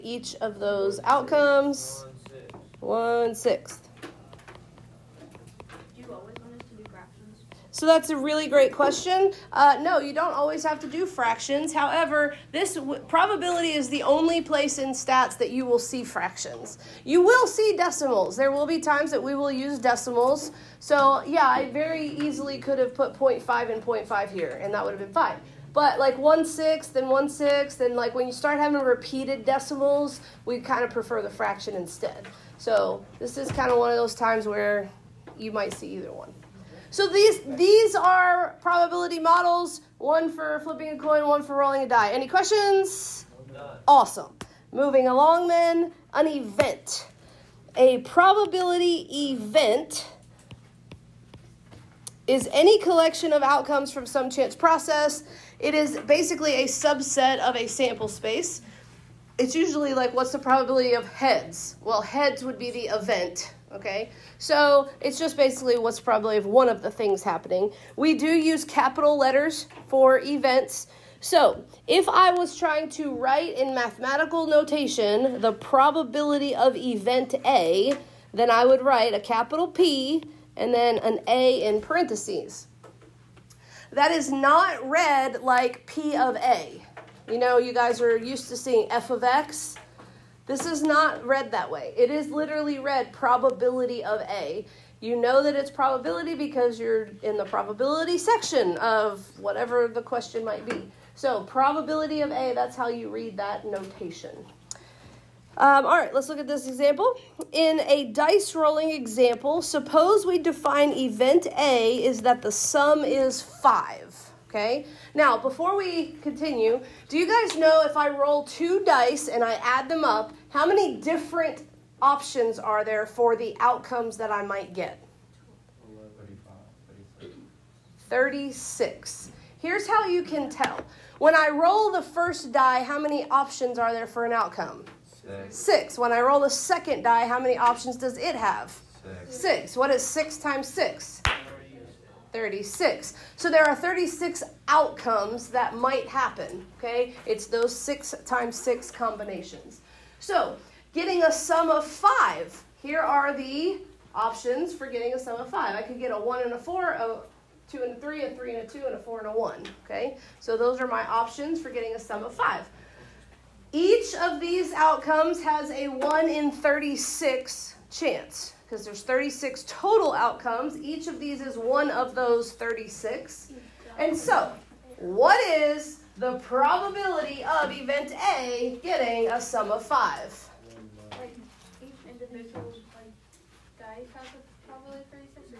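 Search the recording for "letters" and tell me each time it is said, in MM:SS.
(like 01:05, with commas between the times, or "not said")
01:09.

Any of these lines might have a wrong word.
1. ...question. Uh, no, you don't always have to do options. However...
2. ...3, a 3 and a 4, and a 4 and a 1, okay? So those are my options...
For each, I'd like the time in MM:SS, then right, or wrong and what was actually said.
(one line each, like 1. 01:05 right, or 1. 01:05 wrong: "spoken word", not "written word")
1. 00:08 wrong: "fractions", not "options"
2. 02:38 wrong: "2", not "4".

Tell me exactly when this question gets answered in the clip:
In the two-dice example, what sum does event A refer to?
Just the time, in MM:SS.
01:52.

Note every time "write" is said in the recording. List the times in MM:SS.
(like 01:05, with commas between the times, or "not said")
01:13, 01:18.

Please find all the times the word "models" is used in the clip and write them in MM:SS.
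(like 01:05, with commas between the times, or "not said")
00:39.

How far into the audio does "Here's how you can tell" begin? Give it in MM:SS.
02:09.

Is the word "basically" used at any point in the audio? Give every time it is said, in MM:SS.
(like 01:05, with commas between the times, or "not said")
00:55, 01:05.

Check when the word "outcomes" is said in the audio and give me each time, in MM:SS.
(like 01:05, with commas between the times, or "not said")
00:01, 00:53, 02:03, 02:14, 02:24, 02:44, 02:50.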